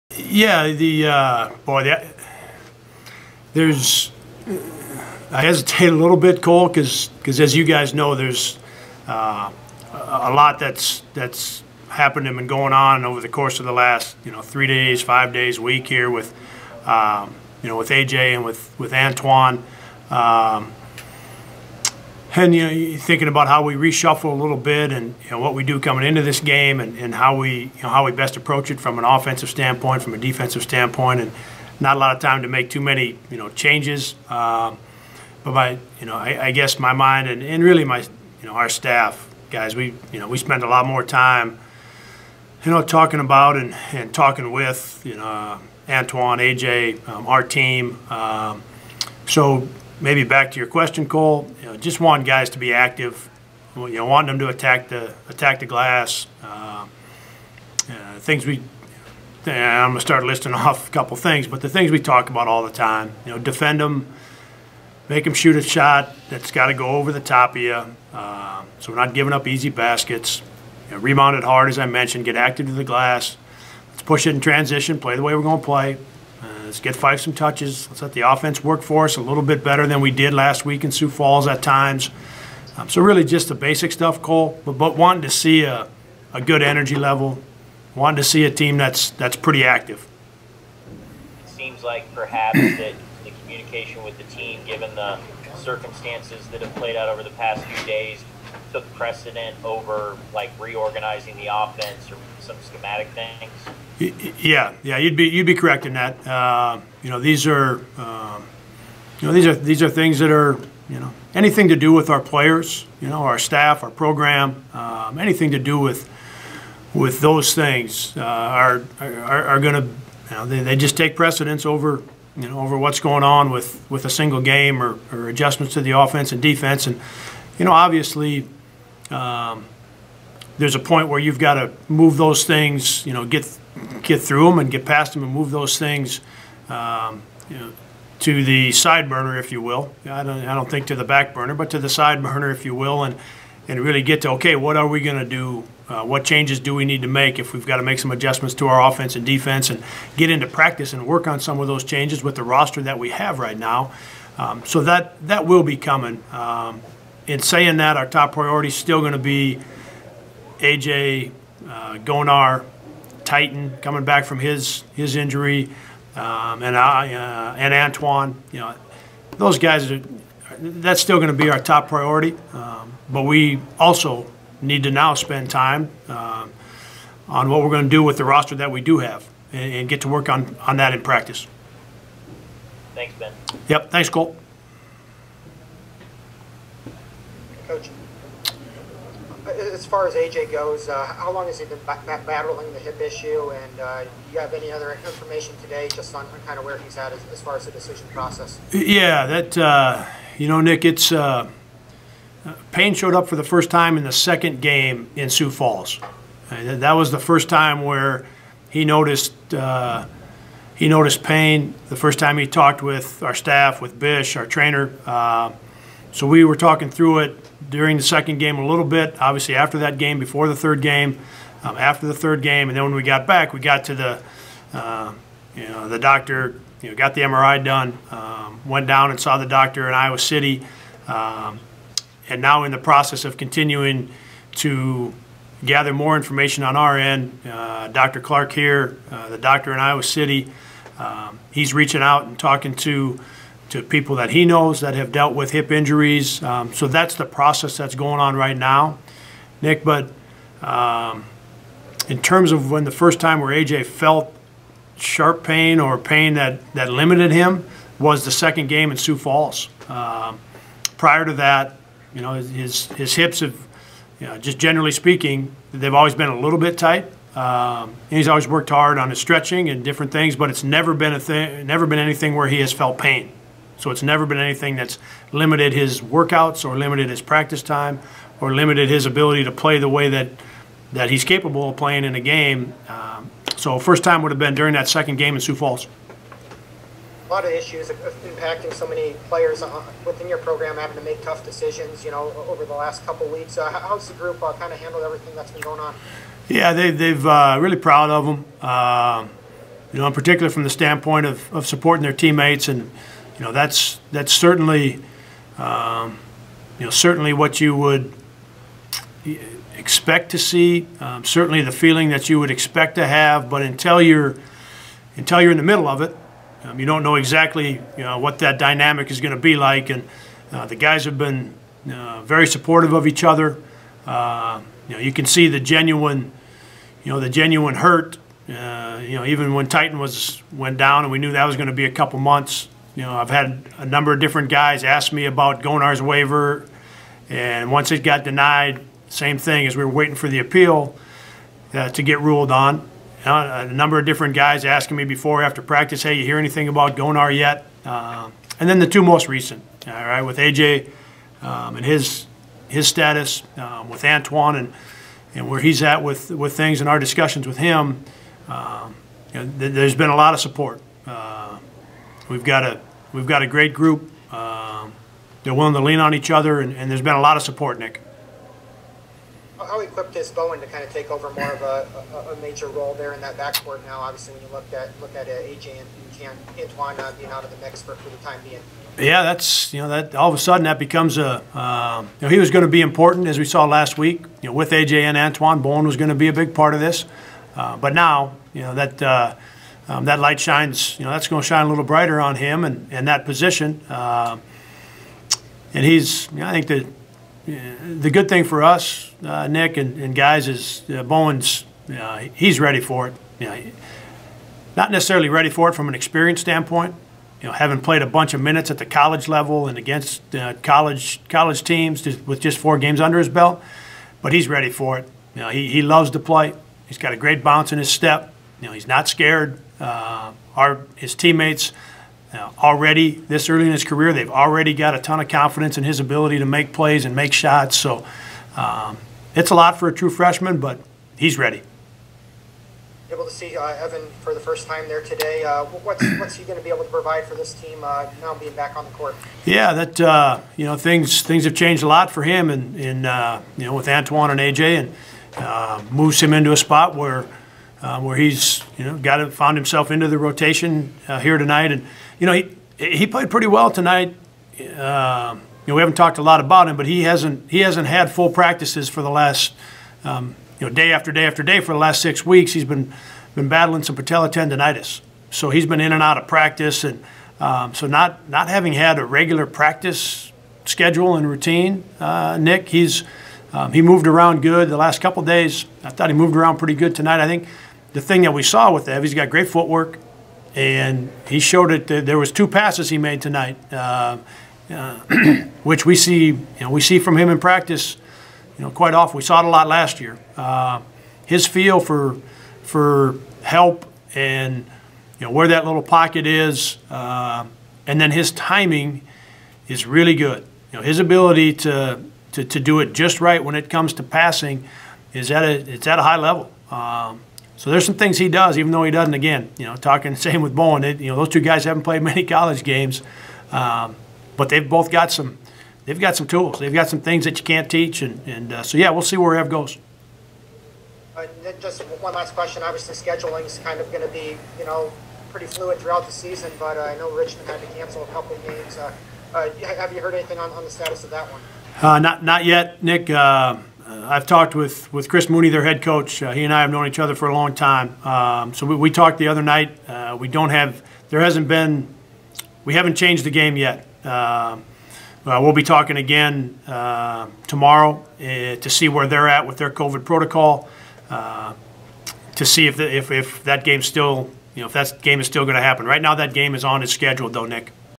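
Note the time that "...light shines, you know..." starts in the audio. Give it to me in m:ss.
6:30.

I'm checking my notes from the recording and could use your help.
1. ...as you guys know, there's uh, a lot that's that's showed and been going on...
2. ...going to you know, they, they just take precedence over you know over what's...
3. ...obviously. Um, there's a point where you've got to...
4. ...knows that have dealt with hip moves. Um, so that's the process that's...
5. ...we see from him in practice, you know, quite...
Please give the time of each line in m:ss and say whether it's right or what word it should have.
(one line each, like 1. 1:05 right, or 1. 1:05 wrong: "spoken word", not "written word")
1. 0:07 wrong: "happened", not "showed"
2. 1:59 right
3. 2:07 right
4. 4:04 wrong: "injuries", not "moves"
5. 8:06 right.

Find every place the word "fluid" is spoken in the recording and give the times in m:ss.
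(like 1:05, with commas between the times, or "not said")
8:45.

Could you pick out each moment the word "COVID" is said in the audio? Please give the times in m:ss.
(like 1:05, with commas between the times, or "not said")
9:09.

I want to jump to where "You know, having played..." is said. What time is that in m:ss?
6:47.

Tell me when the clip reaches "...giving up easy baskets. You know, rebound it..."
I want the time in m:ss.
1:09.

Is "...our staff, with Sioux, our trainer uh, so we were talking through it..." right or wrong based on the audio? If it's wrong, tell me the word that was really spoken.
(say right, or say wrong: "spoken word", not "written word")
wrong: "Bish", not "Sioux".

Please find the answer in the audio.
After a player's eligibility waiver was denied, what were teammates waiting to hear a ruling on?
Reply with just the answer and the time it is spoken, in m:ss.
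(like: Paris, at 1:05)
The appeal, at 5:40.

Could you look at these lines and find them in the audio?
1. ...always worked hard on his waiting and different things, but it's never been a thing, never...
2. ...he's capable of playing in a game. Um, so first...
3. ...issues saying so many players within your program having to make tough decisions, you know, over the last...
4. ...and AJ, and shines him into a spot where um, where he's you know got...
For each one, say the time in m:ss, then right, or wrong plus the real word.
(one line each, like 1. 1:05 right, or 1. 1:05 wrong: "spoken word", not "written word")
1. 4:28 wrong: "stretching", not "waiting"
2. 4:41 right
3. 4:47 wrong: "impacting", not "saying"
4. 7:24 wrong: "moves", not "shines".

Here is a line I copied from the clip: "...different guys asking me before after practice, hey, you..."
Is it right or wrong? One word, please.
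right.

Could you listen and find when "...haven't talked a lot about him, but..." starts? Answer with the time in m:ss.
7:35.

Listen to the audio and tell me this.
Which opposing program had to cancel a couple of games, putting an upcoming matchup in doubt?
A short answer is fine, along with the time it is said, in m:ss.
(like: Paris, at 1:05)
Richmond, at 8:47.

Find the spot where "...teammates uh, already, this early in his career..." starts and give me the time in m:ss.
7:01.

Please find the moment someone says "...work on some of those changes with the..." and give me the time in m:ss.
2:31.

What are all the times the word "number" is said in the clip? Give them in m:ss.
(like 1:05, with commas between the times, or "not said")
5:33, 5:43.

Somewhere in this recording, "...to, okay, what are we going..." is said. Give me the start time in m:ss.
2:24.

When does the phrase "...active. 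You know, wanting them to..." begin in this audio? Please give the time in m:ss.
0:52.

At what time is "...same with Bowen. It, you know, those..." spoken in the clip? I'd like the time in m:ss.
8:30.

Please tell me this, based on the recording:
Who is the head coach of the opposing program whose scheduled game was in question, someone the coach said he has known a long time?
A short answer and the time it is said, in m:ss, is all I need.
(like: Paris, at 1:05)
Chris Mooney, at 8:55.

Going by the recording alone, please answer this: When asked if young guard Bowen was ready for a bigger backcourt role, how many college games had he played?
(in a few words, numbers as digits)
4.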